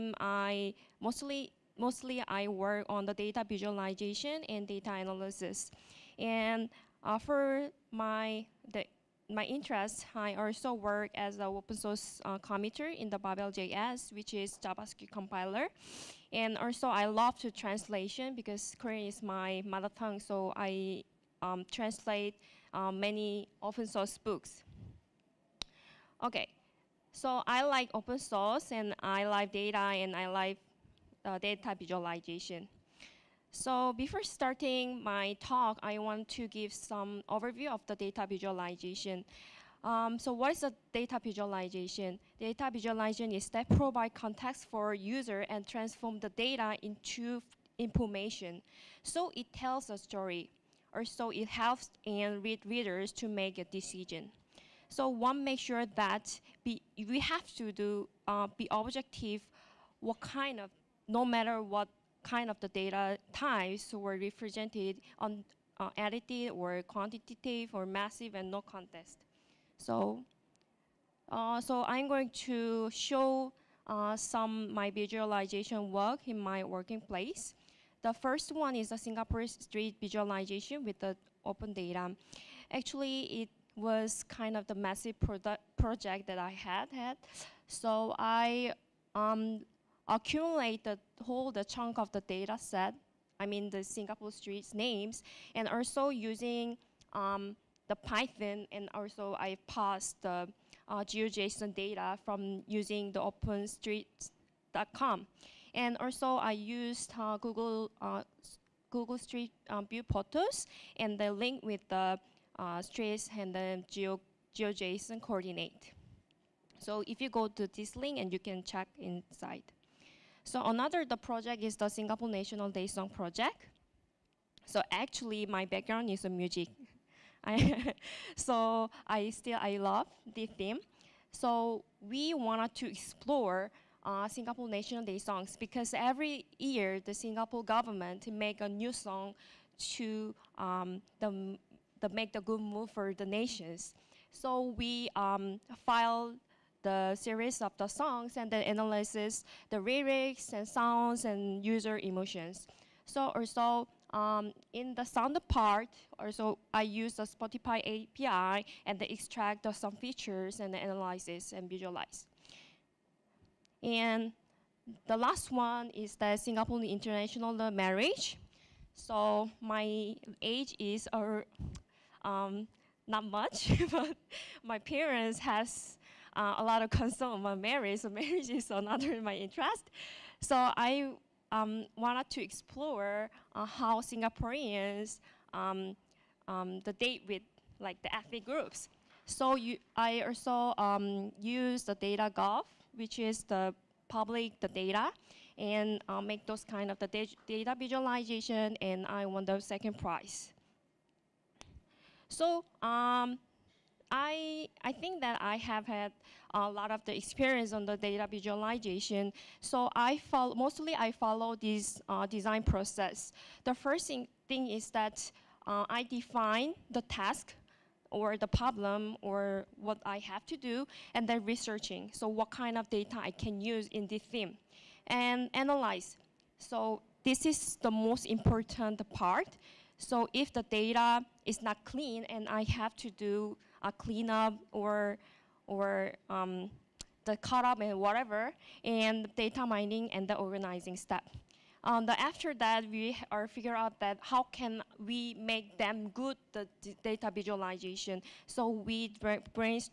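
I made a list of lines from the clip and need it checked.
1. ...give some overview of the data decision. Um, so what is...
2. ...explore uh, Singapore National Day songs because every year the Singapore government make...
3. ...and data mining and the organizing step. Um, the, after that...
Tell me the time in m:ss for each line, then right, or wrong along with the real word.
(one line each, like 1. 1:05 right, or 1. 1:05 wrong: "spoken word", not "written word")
1. 0:36 wrong: "visualization", not "decision"
2. 2:12 right
3. 3:58 right.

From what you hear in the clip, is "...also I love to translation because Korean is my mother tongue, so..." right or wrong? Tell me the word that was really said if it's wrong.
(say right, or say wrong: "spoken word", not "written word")
right.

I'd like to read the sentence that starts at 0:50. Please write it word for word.
or so it helps and read readers to make a decision.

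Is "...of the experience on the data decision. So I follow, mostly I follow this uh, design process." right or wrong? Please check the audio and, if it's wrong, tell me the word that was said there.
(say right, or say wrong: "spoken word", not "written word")
wrong: "visualization", not "decision".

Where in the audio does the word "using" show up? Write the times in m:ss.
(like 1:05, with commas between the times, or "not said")
1:36, 1:42.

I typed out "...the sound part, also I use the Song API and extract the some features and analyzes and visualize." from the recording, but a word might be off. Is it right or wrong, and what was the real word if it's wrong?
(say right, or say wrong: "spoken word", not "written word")
wrong: "Spotify", not "Song".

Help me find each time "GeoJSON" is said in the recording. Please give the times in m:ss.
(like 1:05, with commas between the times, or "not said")
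1:41, 1:54.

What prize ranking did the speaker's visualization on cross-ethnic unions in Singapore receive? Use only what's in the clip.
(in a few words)
second prize.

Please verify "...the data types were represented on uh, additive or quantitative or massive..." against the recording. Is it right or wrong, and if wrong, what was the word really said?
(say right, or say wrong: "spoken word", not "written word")
right.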